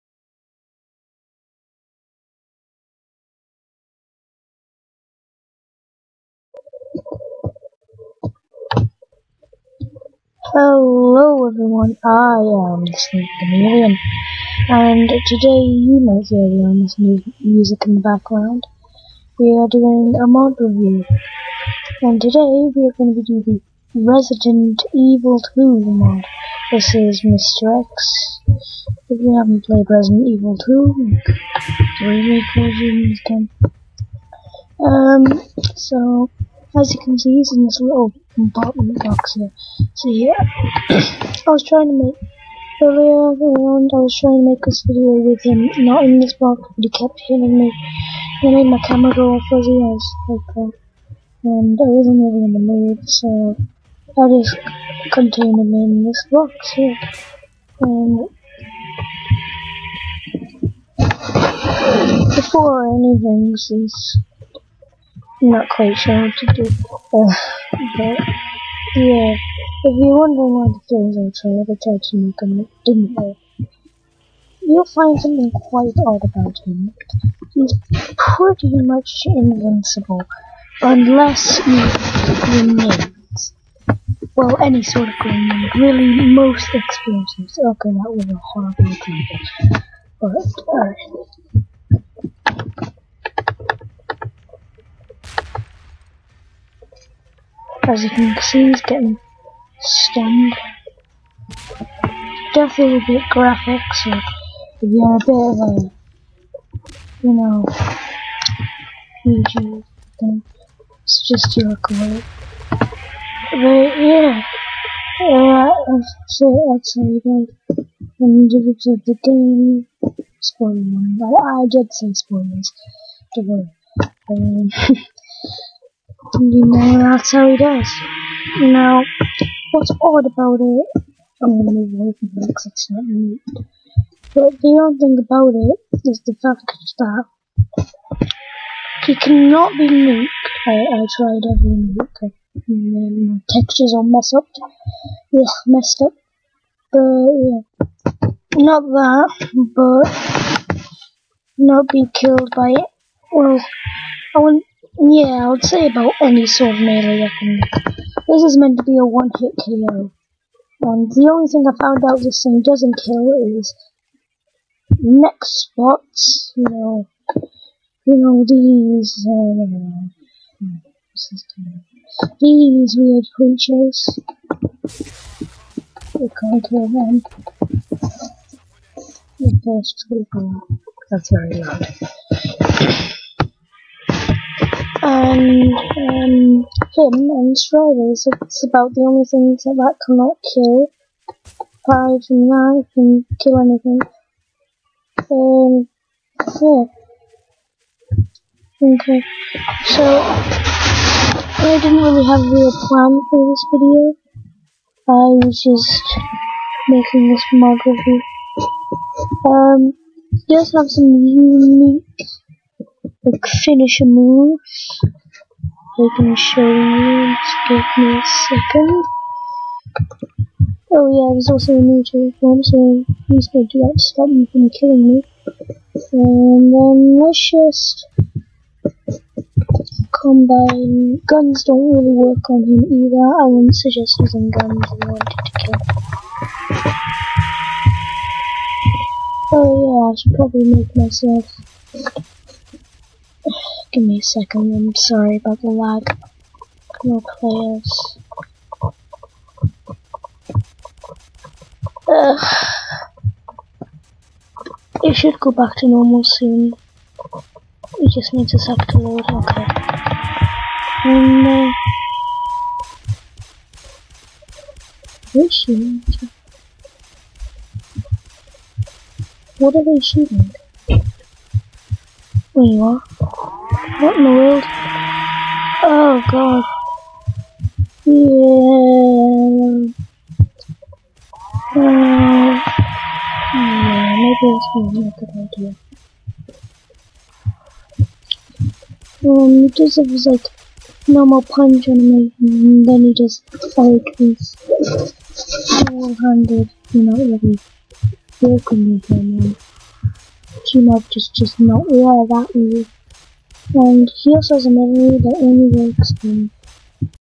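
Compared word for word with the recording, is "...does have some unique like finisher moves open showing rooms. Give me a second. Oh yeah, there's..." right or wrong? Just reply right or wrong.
right.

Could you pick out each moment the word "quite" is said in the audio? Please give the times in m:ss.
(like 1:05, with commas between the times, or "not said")
1:05, 1:15.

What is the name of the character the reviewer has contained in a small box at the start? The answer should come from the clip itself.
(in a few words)
Mr. X.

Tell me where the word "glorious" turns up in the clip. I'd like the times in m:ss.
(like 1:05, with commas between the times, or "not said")
not said.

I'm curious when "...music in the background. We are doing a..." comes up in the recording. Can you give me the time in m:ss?
0:16.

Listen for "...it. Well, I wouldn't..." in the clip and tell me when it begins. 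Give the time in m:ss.
2:32.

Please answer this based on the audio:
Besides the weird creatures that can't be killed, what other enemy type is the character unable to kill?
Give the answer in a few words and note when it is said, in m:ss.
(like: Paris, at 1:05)
Striders, at 3:07.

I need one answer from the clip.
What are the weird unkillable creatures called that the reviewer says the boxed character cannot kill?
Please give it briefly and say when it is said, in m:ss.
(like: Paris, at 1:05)
Nextbots, at 2:45.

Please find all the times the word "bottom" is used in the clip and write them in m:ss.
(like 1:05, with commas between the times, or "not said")
0:38.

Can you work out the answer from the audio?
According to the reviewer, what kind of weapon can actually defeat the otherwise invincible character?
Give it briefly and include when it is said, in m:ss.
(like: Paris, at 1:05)
Grenades, at 1:22.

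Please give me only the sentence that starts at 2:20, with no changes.
I, I tried every nuke, and then my textures are messed up.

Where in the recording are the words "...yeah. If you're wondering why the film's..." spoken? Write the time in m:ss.
1:08.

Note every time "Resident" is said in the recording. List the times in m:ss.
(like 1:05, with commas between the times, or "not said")
0:24, 0:29.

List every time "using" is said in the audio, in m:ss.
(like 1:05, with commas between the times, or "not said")
3:54.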